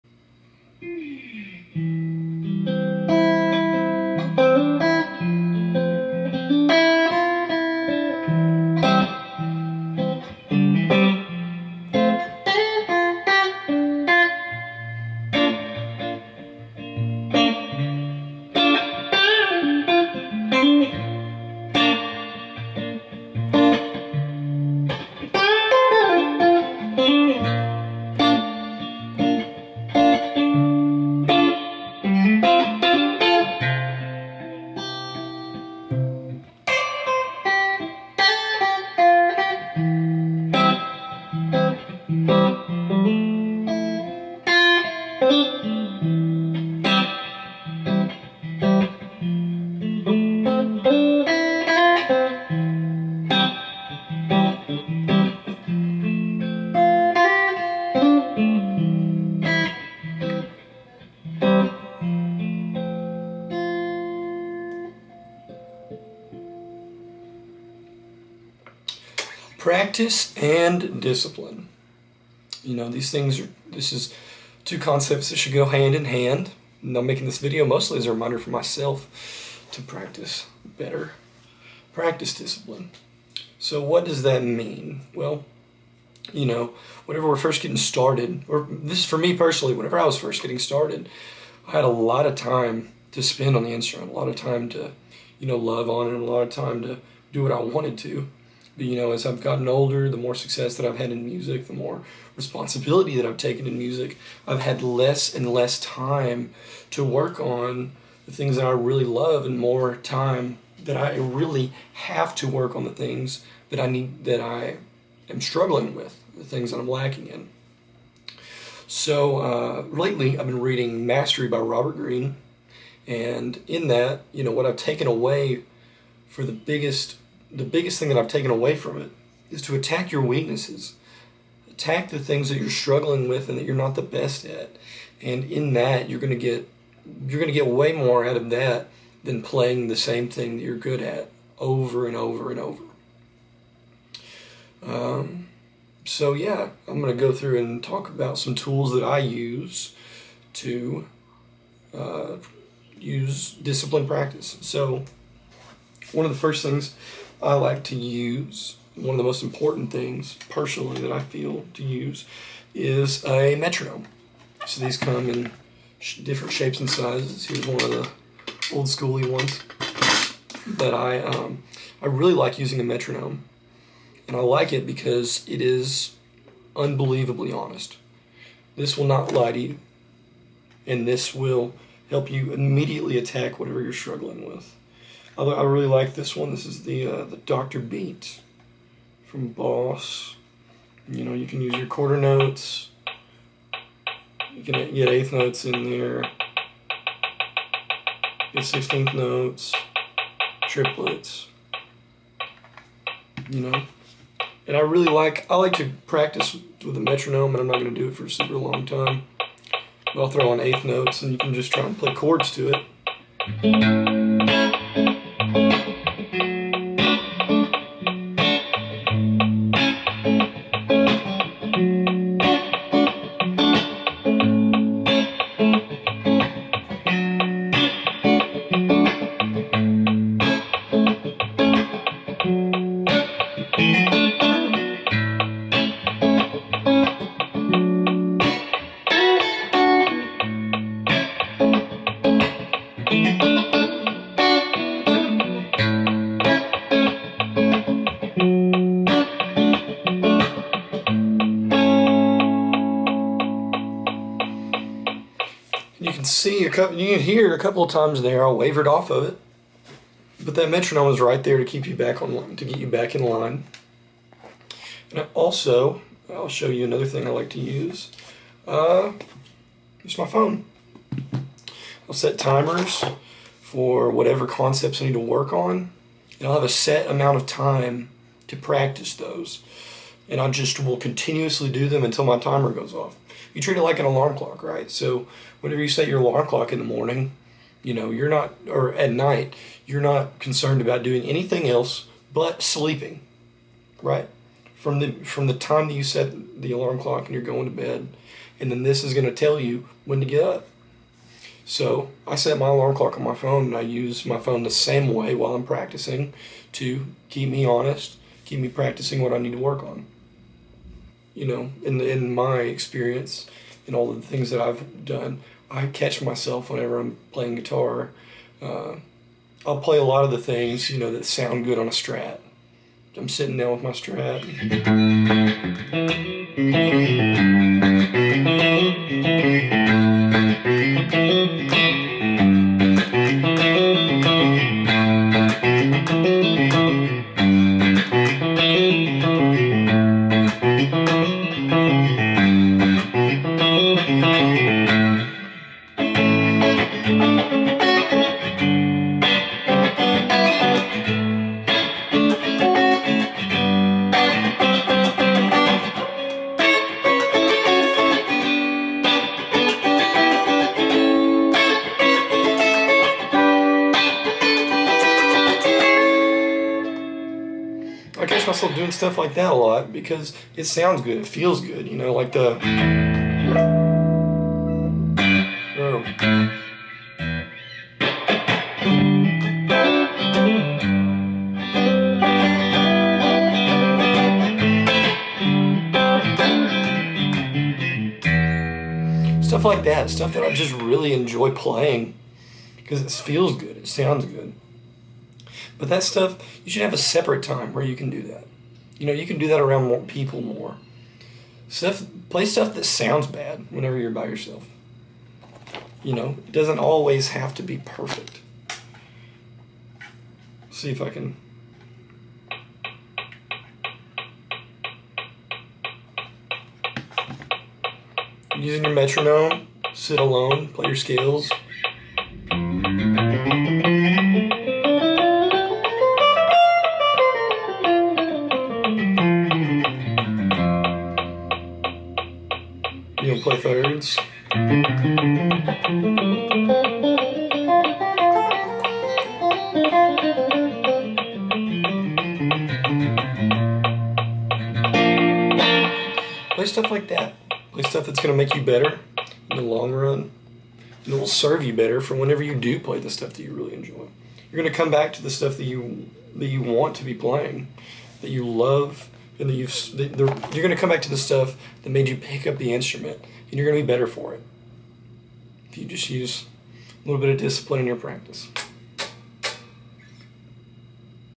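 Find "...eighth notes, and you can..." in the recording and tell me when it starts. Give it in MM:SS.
03:30.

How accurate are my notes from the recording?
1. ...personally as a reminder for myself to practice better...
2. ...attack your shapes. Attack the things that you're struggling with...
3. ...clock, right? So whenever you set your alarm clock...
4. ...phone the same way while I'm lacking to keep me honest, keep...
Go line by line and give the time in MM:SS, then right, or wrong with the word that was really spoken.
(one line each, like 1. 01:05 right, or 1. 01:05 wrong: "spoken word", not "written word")
1. 01:17 wrong: "mostly", not "personally"
2. 02:09 wrong: "weaknesses", not "shapes"
3. 04:44 right
4. 05:04 wrong: "practicing", not "lacking".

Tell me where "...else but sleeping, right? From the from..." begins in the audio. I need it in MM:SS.
04:51.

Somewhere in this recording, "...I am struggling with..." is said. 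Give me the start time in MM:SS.
01:54.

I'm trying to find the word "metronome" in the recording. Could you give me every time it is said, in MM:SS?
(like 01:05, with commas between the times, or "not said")
02:43, 02:52, 03:26, 04:20, 06:58.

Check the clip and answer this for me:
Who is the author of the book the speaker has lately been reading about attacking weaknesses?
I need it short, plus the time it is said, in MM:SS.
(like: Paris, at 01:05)
Robert Greene, at 02:01.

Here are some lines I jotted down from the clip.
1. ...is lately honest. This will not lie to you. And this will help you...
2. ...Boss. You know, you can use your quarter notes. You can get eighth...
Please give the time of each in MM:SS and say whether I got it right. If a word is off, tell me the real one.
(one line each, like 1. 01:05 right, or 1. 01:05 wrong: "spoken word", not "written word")
1. 02:55 wrong: "unbelievably", not "lately"
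2. 03:09 right.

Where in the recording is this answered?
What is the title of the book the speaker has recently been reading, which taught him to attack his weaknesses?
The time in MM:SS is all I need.
02:01.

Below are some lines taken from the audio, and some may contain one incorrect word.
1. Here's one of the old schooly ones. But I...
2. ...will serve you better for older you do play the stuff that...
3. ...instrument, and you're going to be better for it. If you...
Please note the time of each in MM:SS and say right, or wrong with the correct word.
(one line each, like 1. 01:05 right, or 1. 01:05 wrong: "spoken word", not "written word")
1. 02:47 right
2. 07:31 wrong: "whenever", not "older"
3. 07:42 right.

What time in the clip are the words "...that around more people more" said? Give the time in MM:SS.
06:39.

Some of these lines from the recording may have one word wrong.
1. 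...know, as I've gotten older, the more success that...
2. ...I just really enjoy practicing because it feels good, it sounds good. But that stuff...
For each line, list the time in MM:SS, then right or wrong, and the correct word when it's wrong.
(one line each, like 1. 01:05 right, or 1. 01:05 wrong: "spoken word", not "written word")
1. 01:38 right
2. 06:30 wrong: "playing", not "practicing".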